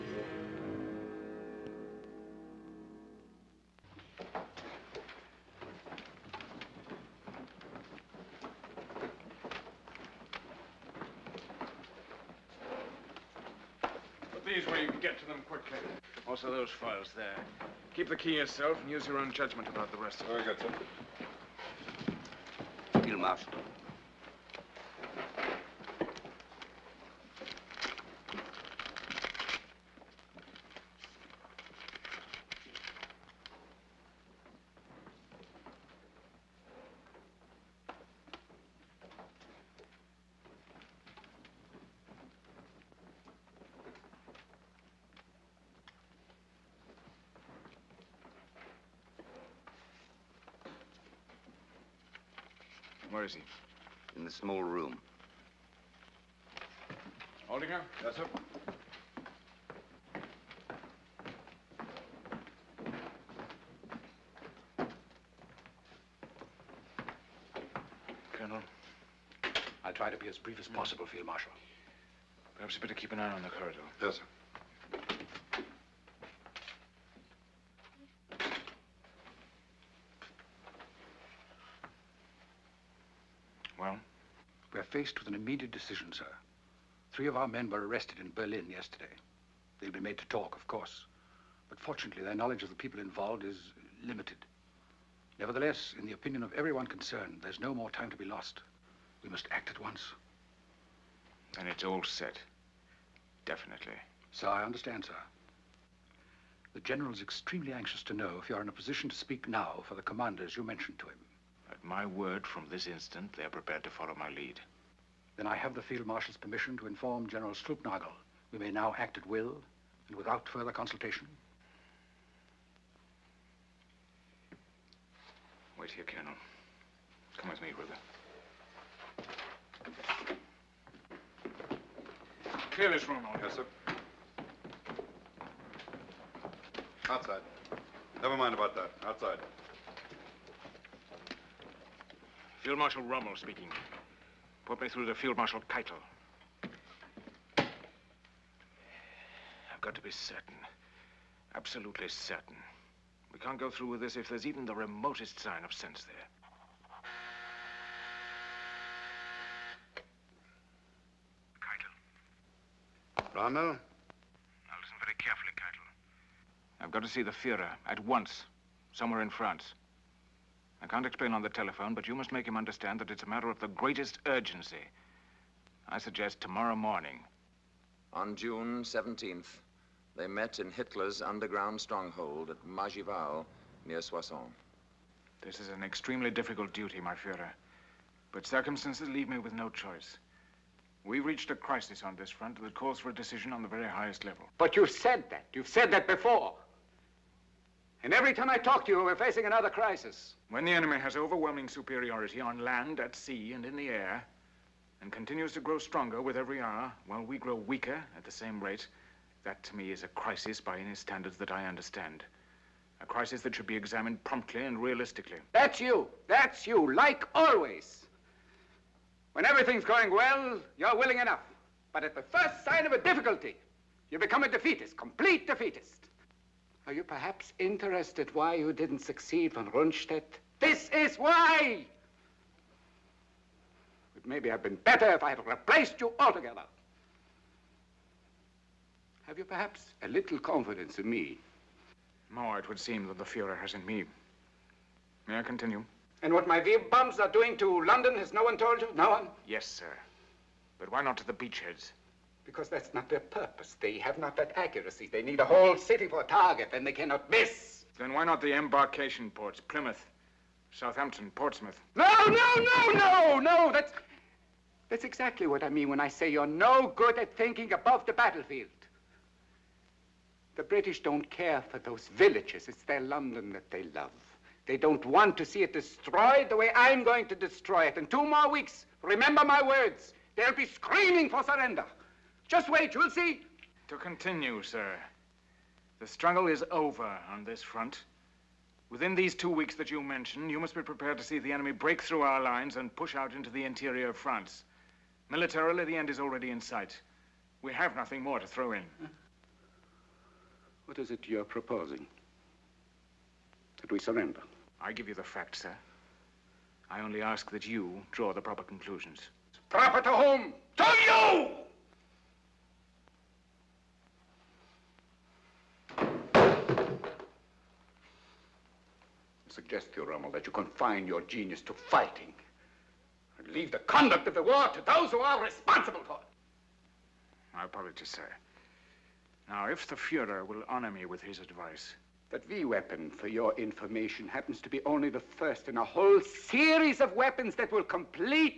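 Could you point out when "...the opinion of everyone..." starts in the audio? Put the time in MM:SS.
01:36.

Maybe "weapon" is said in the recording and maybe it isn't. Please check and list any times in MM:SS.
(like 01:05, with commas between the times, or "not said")
05:32, 05:37.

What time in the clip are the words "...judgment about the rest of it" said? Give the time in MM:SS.
00:19.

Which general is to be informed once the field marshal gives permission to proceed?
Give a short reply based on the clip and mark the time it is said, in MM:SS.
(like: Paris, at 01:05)
General Stülpnagel, at 01:57.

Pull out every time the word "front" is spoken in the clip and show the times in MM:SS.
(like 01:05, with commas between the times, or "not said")
03:12, 04:47.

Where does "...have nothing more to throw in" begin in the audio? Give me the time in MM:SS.
04:57.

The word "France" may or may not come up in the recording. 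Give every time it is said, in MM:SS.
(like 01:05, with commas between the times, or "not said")
02:49, 04:54.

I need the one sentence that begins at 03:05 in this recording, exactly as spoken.
This is an extremely difficult duty, my Führer.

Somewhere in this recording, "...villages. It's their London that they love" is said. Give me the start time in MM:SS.
04:32.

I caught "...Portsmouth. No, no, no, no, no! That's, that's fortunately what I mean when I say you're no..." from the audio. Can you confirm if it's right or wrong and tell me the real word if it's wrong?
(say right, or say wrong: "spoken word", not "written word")
wrong: "exactly", not "fortunately".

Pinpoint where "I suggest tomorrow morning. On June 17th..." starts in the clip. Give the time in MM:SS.
02:55.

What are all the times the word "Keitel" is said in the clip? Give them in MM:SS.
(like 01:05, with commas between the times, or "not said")
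02:25, 02:45.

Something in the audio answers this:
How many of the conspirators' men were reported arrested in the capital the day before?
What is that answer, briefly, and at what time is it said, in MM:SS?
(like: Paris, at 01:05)
3, at 01:27.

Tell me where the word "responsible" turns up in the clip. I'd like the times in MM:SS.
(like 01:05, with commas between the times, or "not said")
05:25.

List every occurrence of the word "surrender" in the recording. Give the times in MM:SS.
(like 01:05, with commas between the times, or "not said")
04:41, 05:03.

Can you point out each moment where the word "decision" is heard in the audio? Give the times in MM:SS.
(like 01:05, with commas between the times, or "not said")
01:25, 03:13.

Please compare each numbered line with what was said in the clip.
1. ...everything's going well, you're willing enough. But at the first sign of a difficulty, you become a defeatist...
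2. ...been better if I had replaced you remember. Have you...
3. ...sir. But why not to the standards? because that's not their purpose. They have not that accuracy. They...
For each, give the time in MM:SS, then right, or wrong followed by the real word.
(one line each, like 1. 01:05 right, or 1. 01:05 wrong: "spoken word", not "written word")
1. 03:39 right
2. 03:54 wrong: "altogether", not "remember"
3. 04:09 wrong: "beachheads", not "standards".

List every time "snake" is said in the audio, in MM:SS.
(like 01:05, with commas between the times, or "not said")
not said.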